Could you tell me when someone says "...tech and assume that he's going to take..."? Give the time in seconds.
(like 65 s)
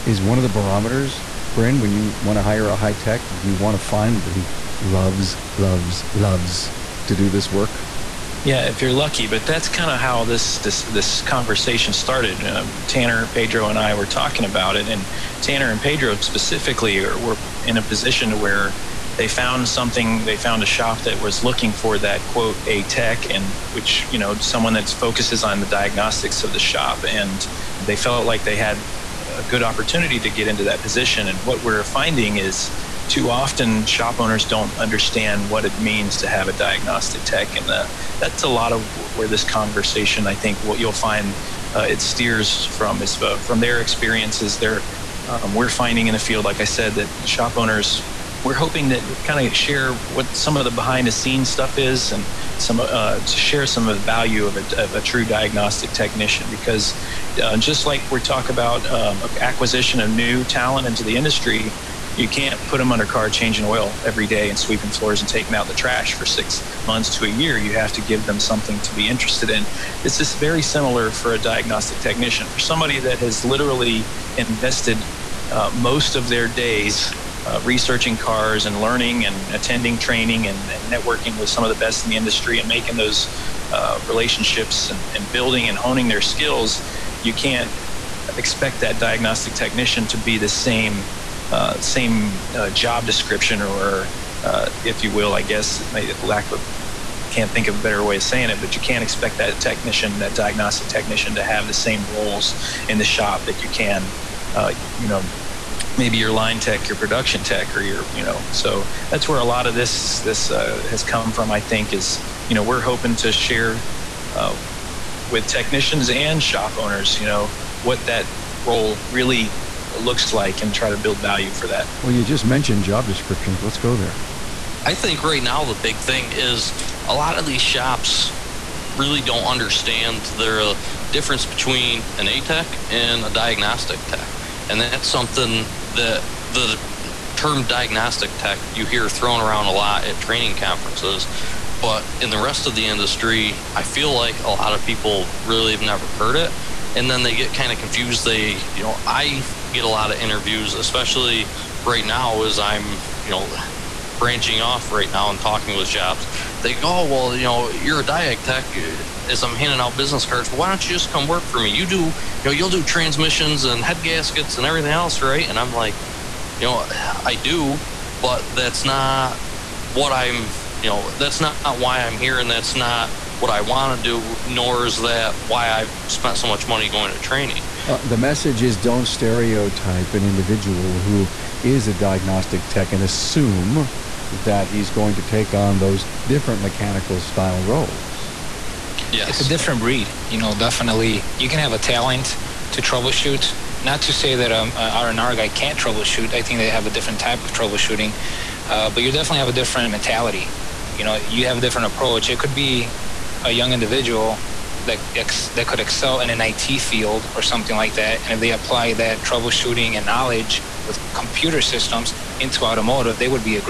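182 s.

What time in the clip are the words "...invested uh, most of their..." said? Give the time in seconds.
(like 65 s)
74 s.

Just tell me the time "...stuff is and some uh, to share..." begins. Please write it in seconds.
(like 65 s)
51 s.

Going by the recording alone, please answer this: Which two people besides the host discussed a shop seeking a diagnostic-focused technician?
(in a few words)
Tanner and Pedro.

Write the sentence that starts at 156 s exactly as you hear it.
They go, oh, well, you know, you're a Diag Tech.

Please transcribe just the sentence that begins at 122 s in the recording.
Well, you just mentioned job descriptions.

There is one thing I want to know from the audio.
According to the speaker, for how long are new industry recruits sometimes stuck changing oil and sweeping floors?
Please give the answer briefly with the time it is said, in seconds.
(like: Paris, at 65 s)
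6 months to a year, at 66 s.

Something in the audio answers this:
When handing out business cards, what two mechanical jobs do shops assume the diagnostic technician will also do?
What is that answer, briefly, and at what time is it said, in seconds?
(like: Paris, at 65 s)
transmissions and head gaskets, at 162 s.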